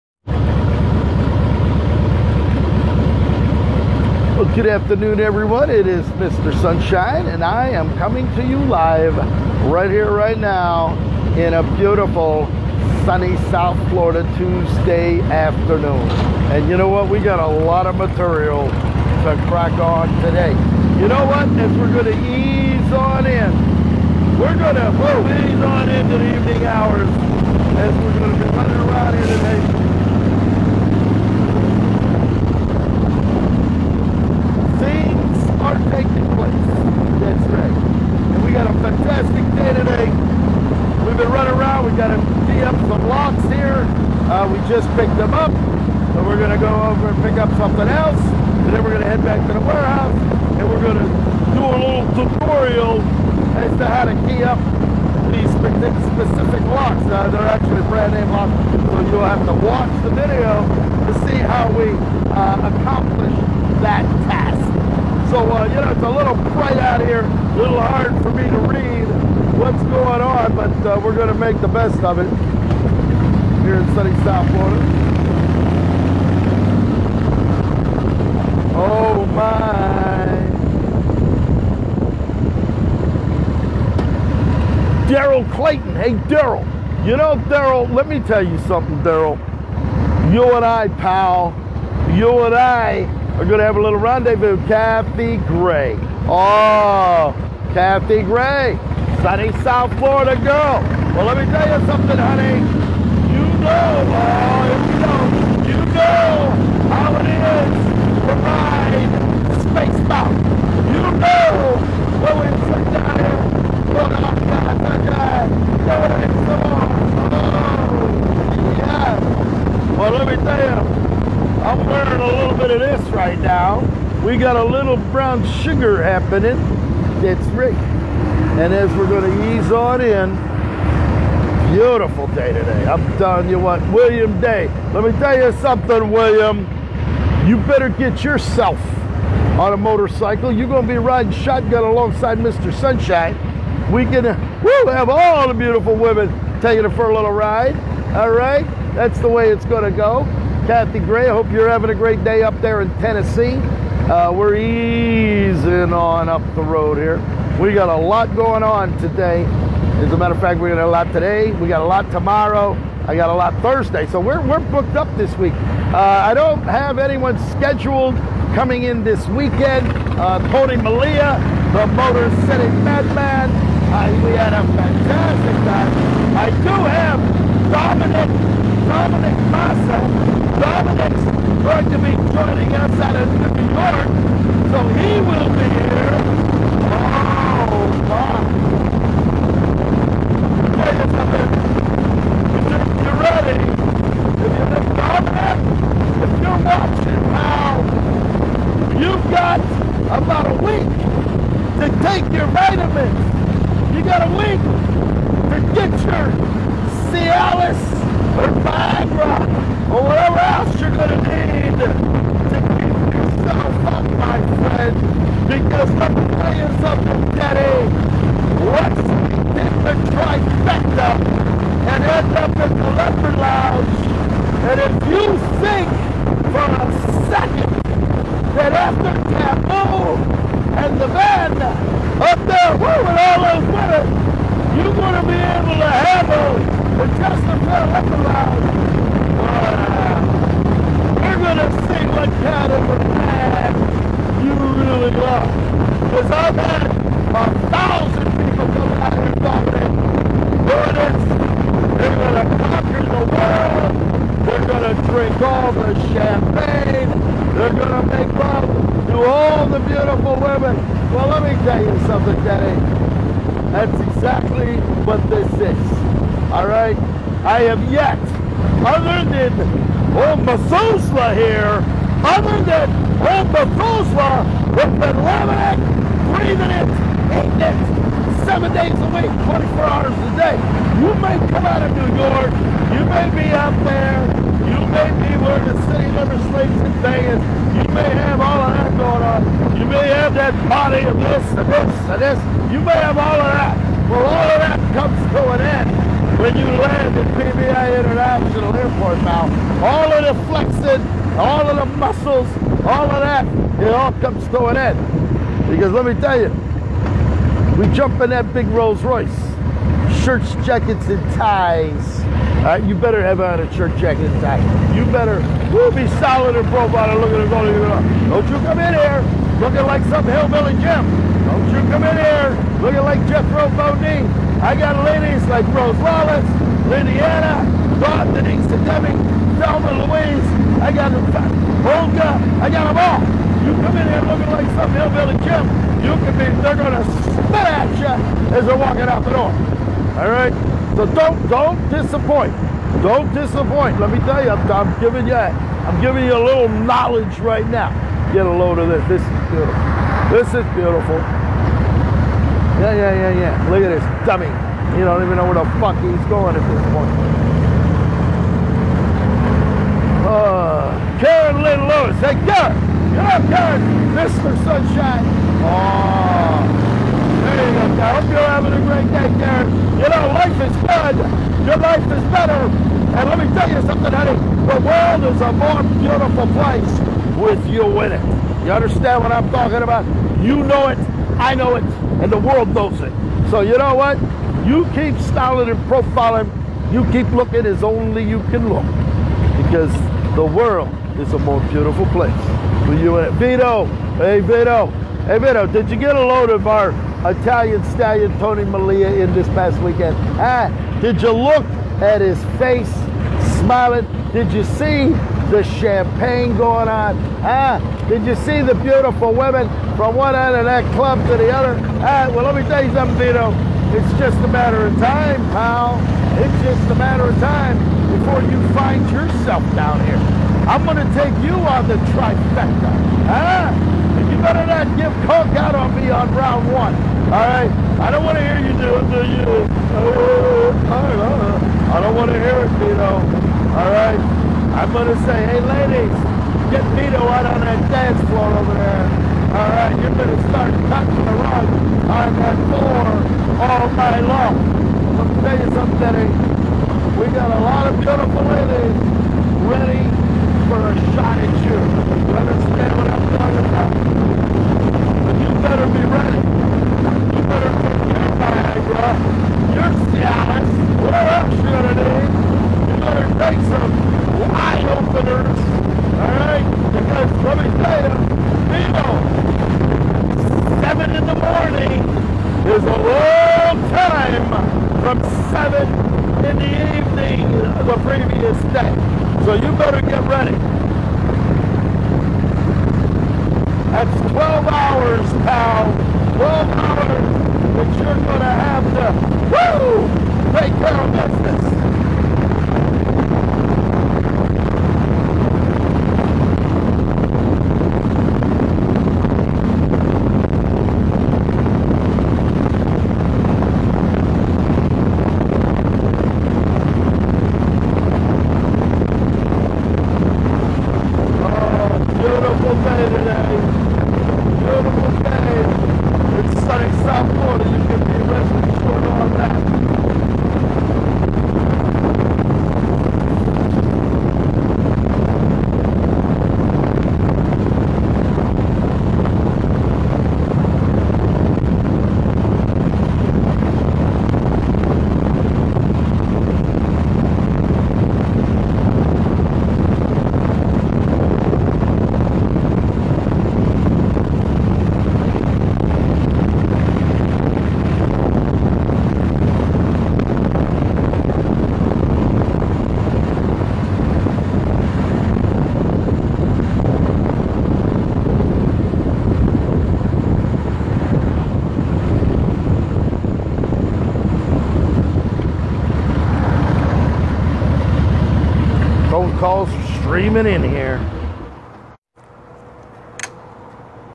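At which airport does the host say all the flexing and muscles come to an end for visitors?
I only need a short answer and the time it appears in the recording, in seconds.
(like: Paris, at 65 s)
PBA International Airport, at 297 s.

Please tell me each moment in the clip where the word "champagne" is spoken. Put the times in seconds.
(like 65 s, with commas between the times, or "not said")
256 s, 405 s.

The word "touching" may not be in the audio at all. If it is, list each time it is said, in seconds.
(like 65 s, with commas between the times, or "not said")
440 s.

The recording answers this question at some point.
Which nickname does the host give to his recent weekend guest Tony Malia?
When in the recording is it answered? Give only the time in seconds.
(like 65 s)
171 s.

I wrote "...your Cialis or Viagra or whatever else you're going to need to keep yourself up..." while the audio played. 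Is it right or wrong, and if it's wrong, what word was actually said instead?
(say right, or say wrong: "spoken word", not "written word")
right.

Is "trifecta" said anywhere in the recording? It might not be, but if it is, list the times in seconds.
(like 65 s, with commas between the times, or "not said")
220 s, 422 s.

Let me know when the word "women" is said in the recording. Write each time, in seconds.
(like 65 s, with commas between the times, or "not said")
145 s, 260 s, 409 s.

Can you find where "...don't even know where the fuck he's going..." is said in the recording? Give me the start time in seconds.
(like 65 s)
355 s.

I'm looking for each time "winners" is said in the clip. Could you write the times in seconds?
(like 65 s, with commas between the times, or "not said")
233 s, 250 s.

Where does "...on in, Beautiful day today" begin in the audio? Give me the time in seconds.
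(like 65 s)
129 s.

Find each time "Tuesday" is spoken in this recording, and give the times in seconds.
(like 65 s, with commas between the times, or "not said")
14 s.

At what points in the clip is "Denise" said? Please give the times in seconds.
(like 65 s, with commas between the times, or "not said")
328 s.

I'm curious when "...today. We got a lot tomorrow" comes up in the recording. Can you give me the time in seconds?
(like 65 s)
161 s.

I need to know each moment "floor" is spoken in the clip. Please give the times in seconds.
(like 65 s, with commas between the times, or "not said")
438 s, 442 s.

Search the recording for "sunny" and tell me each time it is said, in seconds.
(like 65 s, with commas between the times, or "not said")
13 s, 73 s, 99 s.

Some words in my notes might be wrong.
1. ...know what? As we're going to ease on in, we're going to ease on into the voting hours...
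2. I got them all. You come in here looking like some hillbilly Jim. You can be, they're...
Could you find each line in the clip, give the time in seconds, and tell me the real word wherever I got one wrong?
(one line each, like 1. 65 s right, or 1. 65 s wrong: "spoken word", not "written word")
1. 21 s wrong: "evening", not "voting"
2. 332 s right.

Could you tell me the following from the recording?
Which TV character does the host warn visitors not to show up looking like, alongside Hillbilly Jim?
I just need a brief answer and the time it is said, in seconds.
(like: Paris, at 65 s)
Jethro Bodine, at 323 s.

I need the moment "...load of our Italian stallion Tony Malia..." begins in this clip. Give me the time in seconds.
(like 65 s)
396 s.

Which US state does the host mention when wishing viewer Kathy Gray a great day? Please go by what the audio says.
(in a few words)
Tennessee.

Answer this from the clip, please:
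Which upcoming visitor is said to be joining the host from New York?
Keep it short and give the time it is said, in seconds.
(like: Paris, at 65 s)
Dominic Massa, at 178 s.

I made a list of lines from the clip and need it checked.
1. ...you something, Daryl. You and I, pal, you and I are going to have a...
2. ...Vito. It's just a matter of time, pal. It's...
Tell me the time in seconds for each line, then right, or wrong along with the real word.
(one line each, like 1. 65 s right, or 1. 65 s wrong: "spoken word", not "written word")
1. 88 s right
2. 413 s right.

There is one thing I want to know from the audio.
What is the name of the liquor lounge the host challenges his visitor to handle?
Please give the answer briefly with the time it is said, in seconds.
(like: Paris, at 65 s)
Chesterfield Liquor Lounge, at 237 s.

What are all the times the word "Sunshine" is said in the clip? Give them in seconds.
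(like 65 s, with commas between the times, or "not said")
6 s, 142 s, 364 s.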